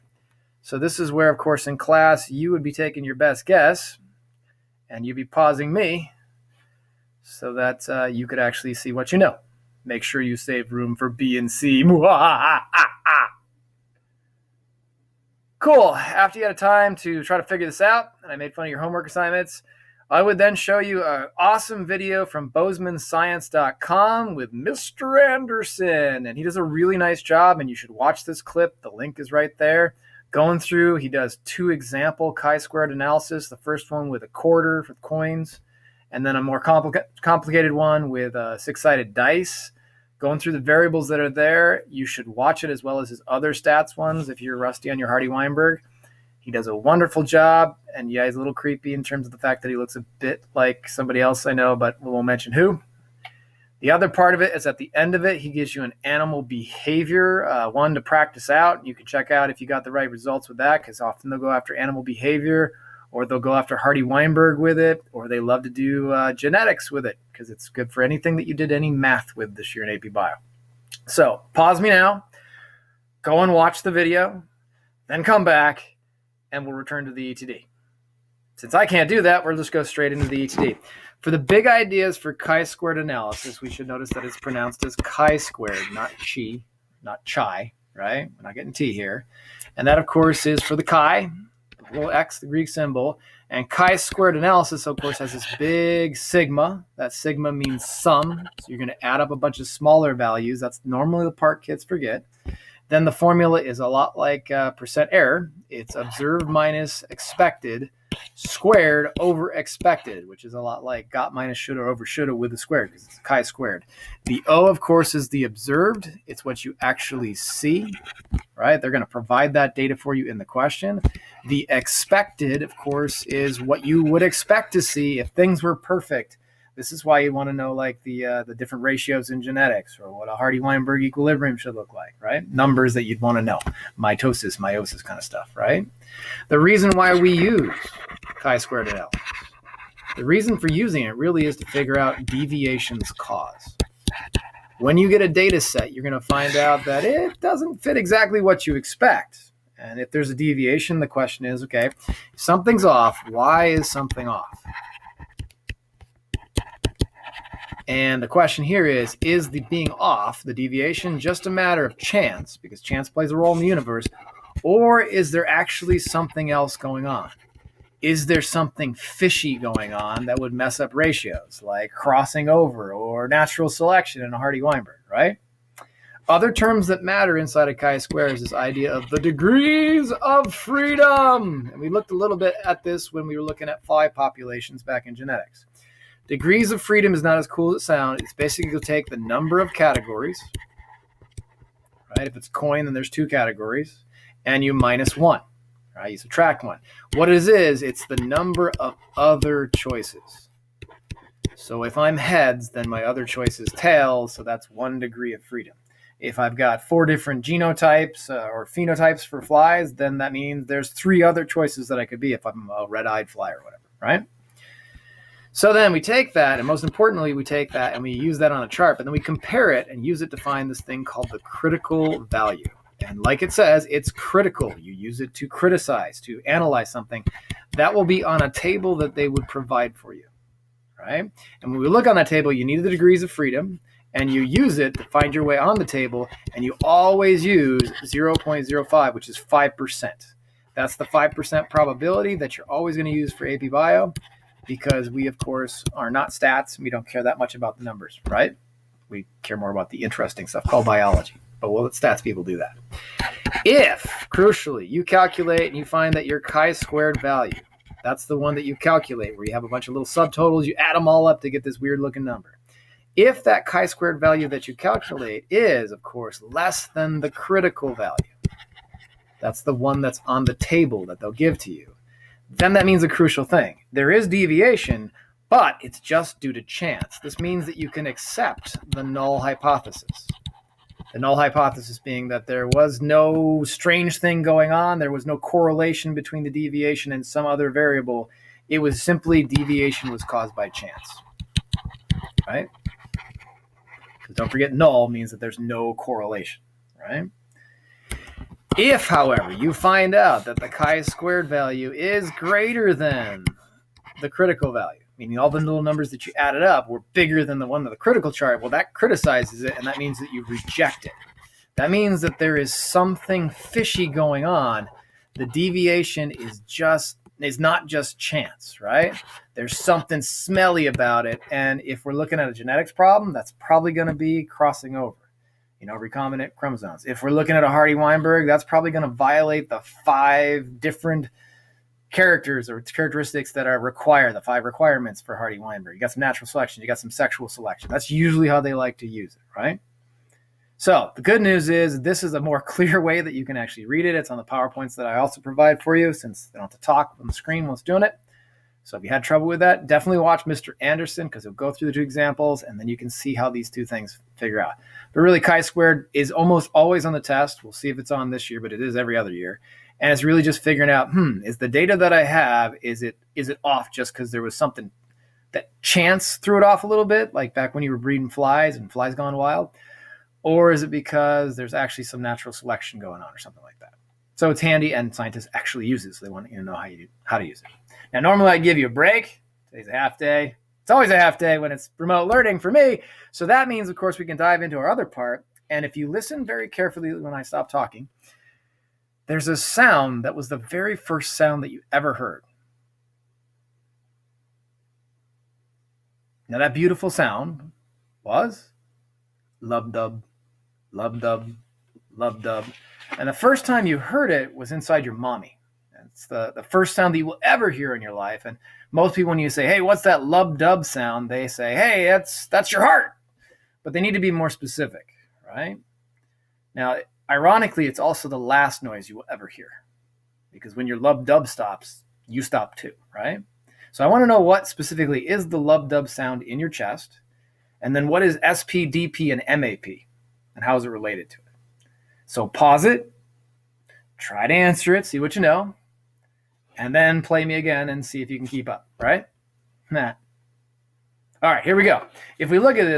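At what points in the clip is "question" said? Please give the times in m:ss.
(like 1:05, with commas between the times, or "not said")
2:00, 2:31, 2:38.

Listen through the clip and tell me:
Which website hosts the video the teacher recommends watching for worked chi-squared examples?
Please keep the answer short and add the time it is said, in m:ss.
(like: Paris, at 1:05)
BozemanScience.com, at 0:22.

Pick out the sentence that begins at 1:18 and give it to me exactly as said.
Since I can't do that, we'll just go straight into the ETD.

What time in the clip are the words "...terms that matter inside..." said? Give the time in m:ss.
2:56.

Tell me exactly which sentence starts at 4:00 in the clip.
That's the 5% probability that you're always going to use for AP Bio because we, of course, are not stats.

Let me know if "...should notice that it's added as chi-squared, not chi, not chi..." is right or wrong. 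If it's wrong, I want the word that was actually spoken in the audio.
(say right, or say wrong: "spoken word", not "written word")
wrong: "pronounced", not "added".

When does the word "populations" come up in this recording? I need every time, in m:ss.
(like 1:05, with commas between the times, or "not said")
3:04.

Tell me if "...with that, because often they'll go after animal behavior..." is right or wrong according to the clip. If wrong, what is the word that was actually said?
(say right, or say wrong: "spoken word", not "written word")
right.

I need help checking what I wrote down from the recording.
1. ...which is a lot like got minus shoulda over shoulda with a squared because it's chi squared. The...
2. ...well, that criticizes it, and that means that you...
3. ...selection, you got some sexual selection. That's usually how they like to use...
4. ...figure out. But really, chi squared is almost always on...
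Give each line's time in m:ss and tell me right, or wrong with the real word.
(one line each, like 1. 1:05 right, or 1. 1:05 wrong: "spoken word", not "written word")
1. 1:50 right
2. 5:08 right
3. 5:36 right
4. 5:54 right.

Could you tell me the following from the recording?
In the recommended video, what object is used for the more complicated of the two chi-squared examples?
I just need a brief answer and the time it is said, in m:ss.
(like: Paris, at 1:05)
six-sided dice, at 0:38.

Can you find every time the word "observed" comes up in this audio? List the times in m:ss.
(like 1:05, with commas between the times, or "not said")
1:45, 1:55.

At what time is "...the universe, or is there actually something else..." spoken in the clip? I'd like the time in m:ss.
2:43.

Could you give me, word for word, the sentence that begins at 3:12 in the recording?
If it's coin, then there's two categories, and you minus one, right?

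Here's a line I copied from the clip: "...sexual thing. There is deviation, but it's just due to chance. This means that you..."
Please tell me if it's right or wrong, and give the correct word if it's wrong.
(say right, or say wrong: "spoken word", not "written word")
wrong: "crucial", not "sexual".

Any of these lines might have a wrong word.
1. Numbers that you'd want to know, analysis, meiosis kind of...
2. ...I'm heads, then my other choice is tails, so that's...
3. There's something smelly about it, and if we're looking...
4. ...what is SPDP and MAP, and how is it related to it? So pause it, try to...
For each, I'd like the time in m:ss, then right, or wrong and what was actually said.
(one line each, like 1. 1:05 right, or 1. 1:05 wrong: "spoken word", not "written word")
1. 2:12 wrong: "mitosis", not "analysis"
2. 3:21 right
3. 5:19 right
4. 7:08 right.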